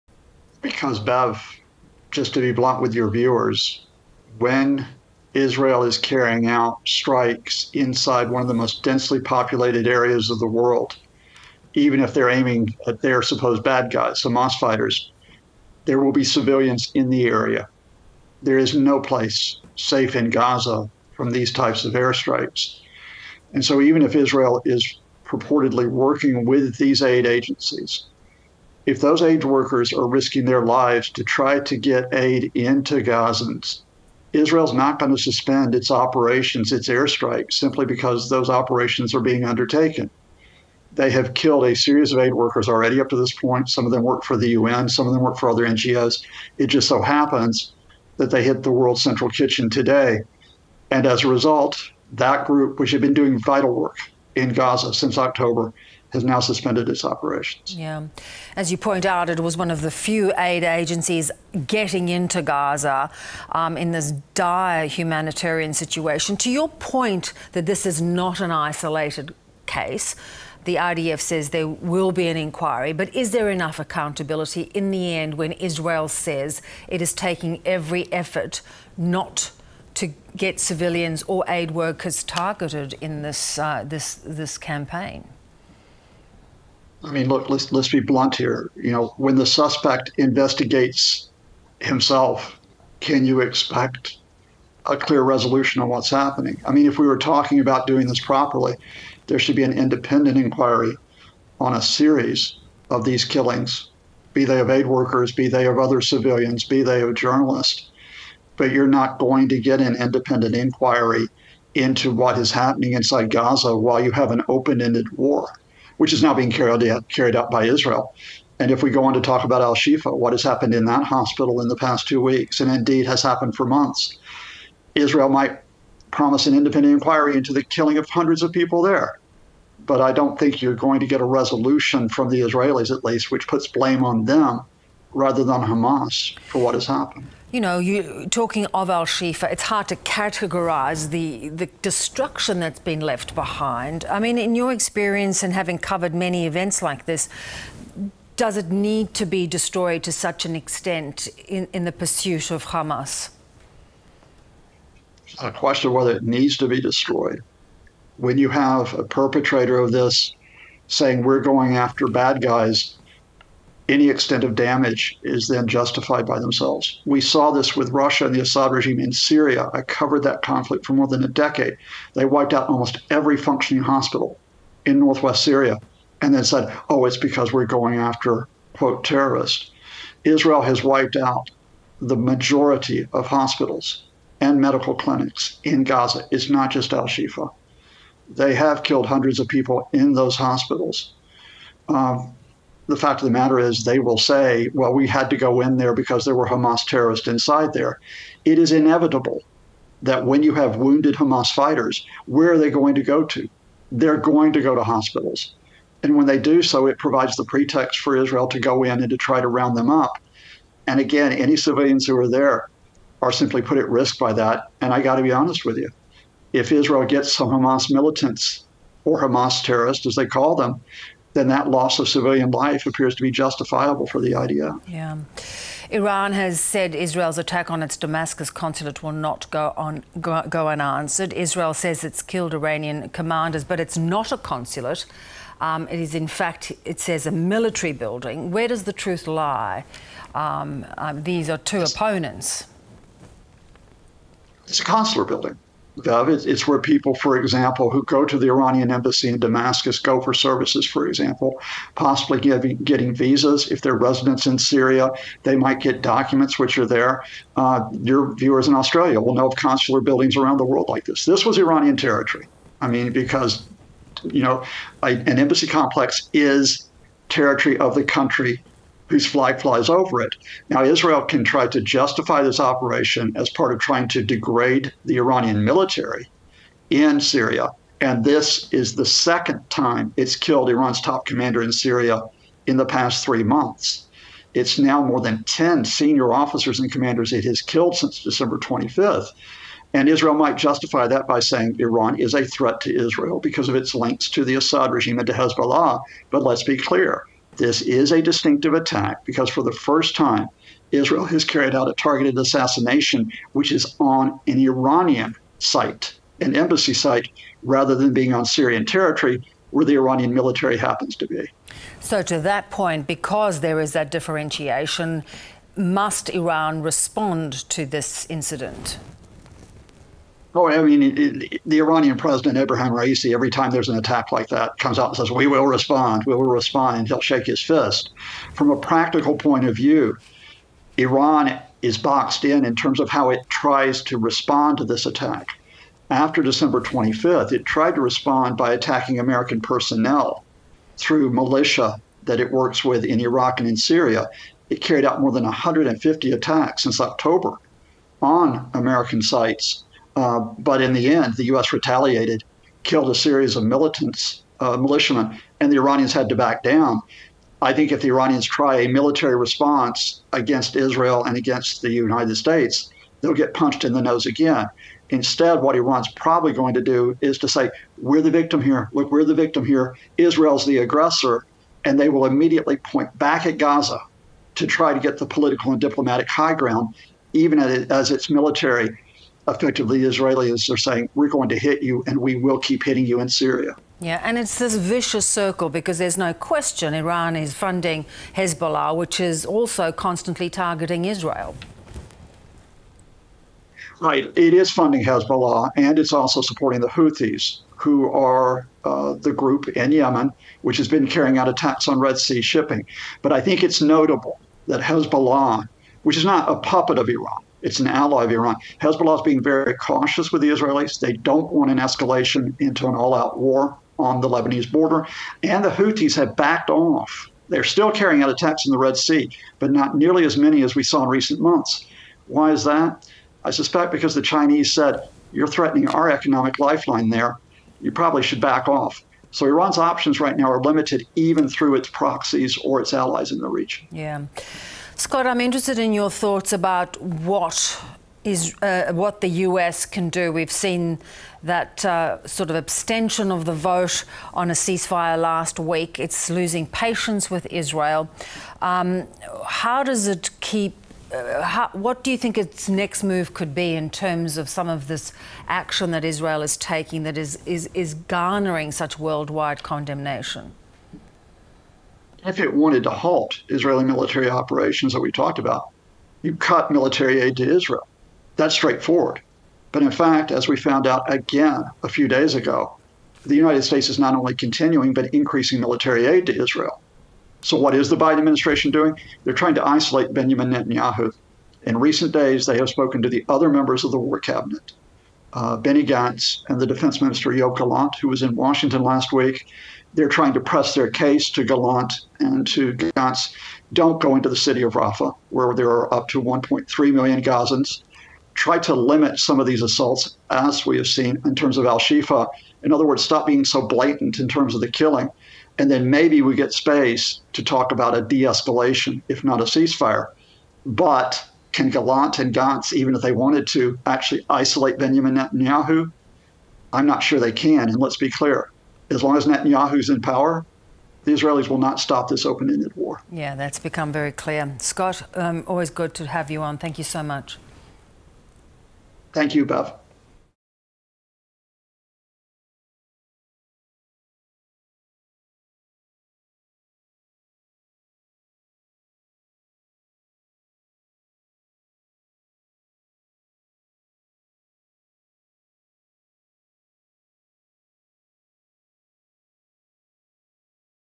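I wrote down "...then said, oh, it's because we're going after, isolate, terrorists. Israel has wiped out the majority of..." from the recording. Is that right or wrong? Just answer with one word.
wrong.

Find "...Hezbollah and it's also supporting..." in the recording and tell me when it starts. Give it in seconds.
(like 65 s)
395 s.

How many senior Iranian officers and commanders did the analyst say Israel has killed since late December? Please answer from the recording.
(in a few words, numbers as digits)
More than 10.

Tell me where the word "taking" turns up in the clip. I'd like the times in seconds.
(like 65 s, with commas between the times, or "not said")
77 s, 456 s.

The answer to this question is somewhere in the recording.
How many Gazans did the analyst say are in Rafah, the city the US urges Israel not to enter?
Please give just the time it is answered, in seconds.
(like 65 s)
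496 s.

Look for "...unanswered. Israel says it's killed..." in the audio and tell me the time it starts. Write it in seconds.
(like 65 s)
230 s.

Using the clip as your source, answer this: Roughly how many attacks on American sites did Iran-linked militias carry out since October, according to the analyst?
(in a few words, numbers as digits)
More than 150.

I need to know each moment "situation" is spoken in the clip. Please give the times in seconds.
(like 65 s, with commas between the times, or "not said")
65 s.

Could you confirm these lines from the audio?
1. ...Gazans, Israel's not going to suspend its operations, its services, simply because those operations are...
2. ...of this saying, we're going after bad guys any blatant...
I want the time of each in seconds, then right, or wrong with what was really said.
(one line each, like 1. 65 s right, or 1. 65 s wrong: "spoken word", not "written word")
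1. 33 s wrong: "airstrikes", not "services"
2. 159 s wrong: "extent", not "blatant".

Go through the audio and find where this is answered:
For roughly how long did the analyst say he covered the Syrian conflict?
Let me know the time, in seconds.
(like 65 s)
170 s.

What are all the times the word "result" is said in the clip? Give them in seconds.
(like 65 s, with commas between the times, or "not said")
51 s.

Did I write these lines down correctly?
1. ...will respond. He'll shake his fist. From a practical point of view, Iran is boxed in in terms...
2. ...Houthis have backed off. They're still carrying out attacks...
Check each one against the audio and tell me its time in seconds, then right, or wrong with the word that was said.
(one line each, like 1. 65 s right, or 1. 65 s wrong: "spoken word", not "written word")
1. 326 s right
2. 415 s right.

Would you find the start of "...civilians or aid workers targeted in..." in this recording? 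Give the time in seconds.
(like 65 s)
80 s.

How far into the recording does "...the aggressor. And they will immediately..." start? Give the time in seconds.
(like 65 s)
370 s.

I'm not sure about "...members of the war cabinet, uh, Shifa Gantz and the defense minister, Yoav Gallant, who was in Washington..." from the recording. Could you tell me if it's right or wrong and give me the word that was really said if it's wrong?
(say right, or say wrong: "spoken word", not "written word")
wrong: "Benny", not "Shifa".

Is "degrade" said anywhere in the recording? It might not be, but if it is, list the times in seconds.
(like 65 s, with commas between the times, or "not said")
274 s.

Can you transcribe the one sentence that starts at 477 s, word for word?
So, what is the Biden administration doing?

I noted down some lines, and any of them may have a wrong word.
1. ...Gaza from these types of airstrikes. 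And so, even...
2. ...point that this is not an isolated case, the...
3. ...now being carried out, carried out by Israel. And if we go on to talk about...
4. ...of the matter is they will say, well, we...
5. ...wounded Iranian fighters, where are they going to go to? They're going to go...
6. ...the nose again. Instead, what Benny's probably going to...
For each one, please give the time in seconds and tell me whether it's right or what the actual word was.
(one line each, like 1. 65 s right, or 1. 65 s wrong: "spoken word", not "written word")
1. 20 s right
2. 66 s right
3. 116 s right
4. 193 s right
5. 200 s wrong: "Hamas", not "Iranian"
6. 363 s wrong: "Iran", not "Benny".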